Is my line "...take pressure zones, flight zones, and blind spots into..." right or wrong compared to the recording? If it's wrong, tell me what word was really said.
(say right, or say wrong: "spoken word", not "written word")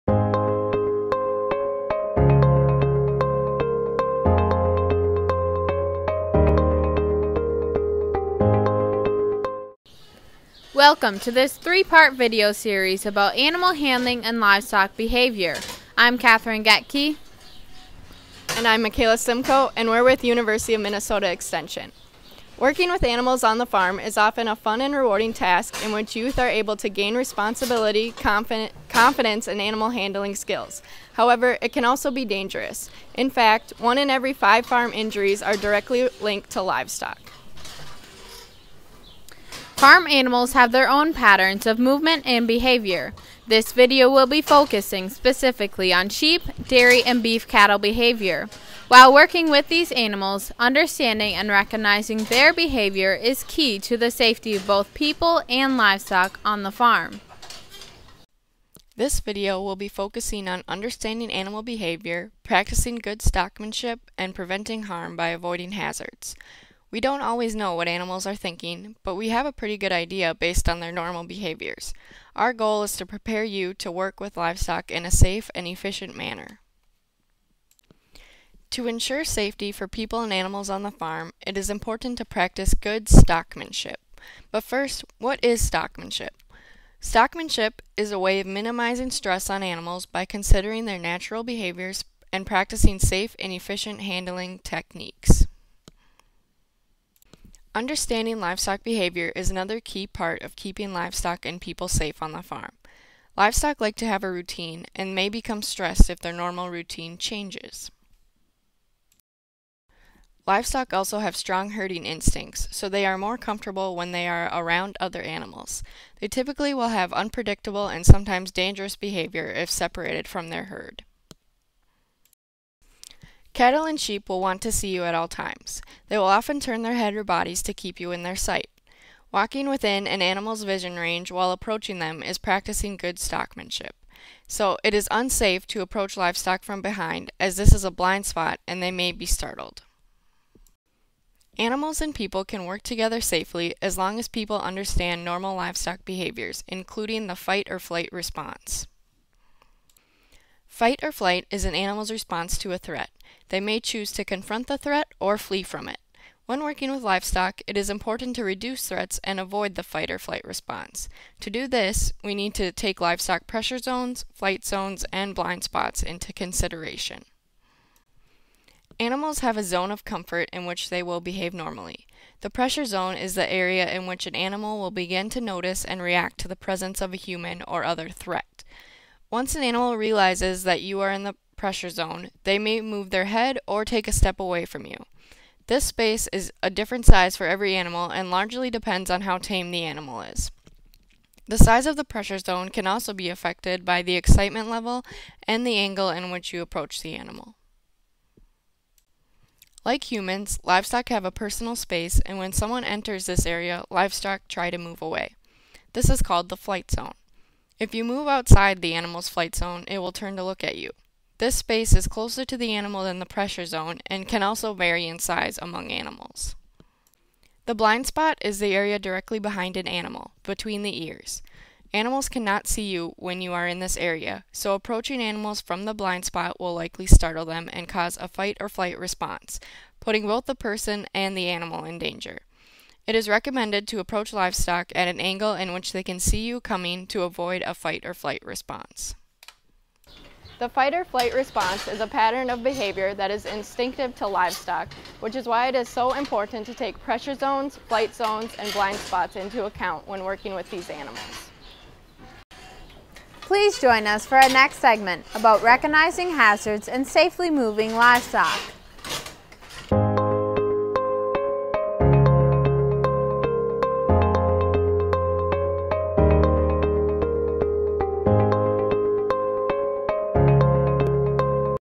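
right.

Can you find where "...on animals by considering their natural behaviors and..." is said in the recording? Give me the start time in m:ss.
1:29.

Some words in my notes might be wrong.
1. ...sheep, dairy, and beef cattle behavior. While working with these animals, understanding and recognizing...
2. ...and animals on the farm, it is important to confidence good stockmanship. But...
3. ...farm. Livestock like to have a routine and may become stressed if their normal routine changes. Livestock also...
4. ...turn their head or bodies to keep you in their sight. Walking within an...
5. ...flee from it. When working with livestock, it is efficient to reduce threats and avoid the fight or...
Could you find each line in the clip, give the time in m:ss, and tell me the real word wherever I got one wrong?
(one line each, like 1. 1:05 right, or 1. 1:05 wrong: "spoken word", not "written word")
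1. 0:46 right
2. 1:20 wrong: "practice", not "confidence"
3. 1:42 right
4. 2:06 right
5. 2:35 wrong: "important", not "efficient".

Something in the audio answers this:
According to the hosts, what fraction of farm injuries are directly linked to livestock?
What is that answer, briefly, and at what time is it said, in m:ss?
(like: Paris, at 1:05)
1 in 5, at 0:33.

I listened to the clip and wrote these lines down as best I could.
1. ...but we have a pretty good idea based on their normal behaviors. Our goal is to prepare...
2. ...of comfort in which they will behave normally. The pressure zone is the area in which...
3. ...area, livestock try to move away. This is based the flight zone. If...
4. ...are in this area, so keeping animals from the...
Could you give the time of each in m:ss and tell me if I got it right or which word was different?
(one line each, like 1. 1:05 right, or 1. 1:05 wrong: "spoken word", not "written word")
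1. 1:09 right
2. 2:49 right
3. 3:23 wrong: "called", not "based"
4. 3:43 wrong: "approaching", not "keeping".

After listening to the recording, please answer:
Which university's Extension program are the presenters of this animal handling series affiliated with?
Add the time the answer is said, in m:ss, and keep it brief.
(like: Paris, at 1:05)
University of Minnesota, at 0:20.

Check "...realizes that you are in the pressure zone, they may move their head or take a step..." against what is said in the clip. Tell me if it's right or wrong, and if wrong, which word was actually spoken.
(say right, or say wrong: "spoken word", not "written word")
right.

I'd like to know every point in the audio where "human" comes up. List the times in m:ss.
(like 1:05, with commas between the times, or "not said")
2:57, 3:20.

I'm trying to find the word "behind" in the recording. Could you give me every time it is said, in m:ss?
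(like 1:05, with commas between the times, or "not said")
2:16, 3:39.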